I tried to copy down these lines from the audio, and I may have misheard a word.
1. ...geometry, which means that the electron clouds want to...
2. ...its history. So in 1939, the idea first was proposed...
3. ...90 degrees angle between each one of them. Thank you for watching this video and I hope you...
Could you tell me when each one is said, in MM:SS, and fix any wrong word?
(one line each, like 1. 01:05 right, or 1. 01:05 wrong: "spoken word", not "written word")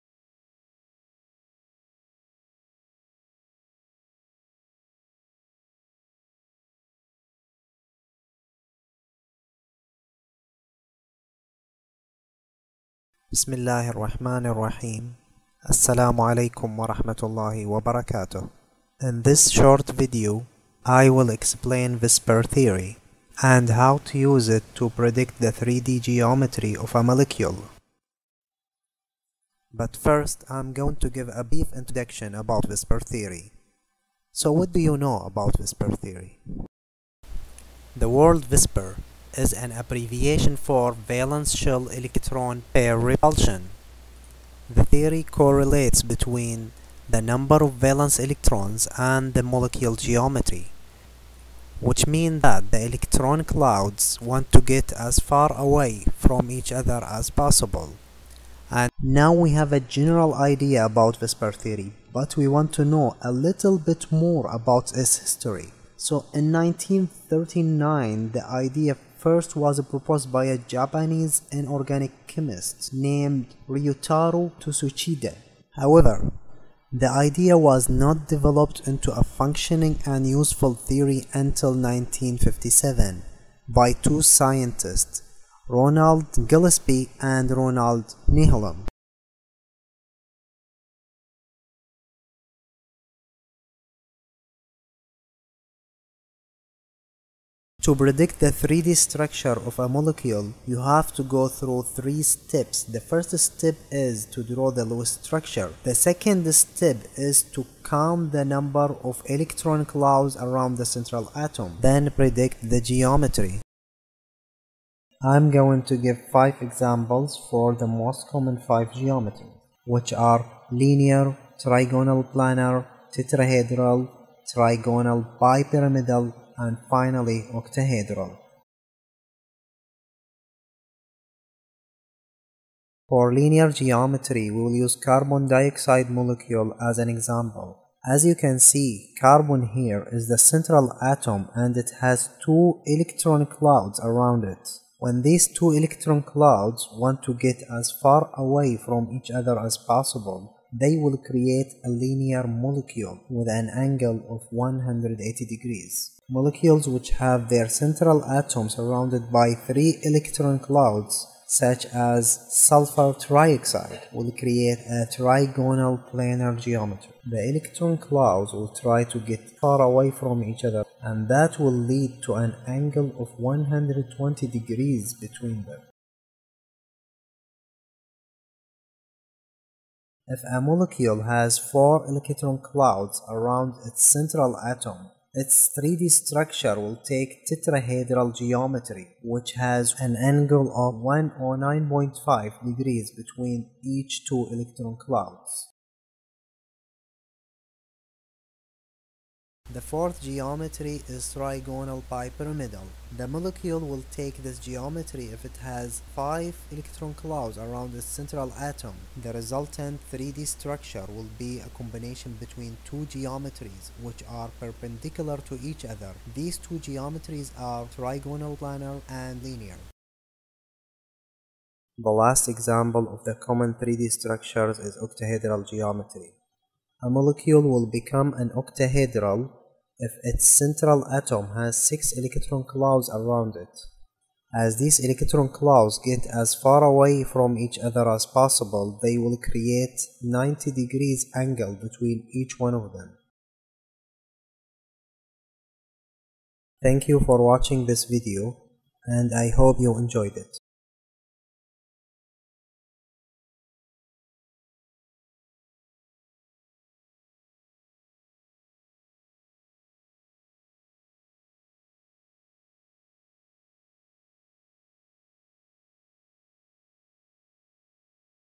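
1. 00:49 right
2. 01:04 right
3. 04:00 right.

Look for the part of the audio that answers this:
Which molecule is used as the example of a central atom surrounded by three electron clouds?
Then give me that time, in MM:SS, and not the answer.
02:42.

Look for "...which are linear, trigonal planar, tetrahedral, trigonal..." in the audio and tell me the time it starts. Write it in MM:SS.
01:59.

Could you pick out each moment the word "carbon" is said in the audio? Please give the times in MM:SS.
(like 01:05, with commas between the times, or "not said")
02:15, 02:19.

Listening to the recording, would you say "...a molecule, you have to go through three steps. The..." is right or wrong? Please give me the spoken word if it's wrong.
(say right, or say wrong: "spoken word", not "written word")
right.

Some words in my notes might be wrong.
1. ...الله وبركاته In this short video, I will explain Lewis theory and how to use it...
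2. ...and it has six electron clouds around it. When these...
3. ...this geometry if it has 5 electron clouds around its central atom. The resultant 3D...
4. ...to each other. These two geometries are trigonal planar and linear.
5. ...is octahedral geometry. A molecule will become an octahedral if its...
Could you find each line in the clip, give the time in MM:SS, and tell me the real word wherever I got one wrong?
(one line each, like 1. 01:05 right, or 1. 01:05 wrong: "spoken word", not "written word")
1. 00:17 wrong: "VSEPR", not "Lewis"
2. 02:21 wrong: "two", not "six"
3. 03:24 right
4. 03:35 right
5. 03:44 right.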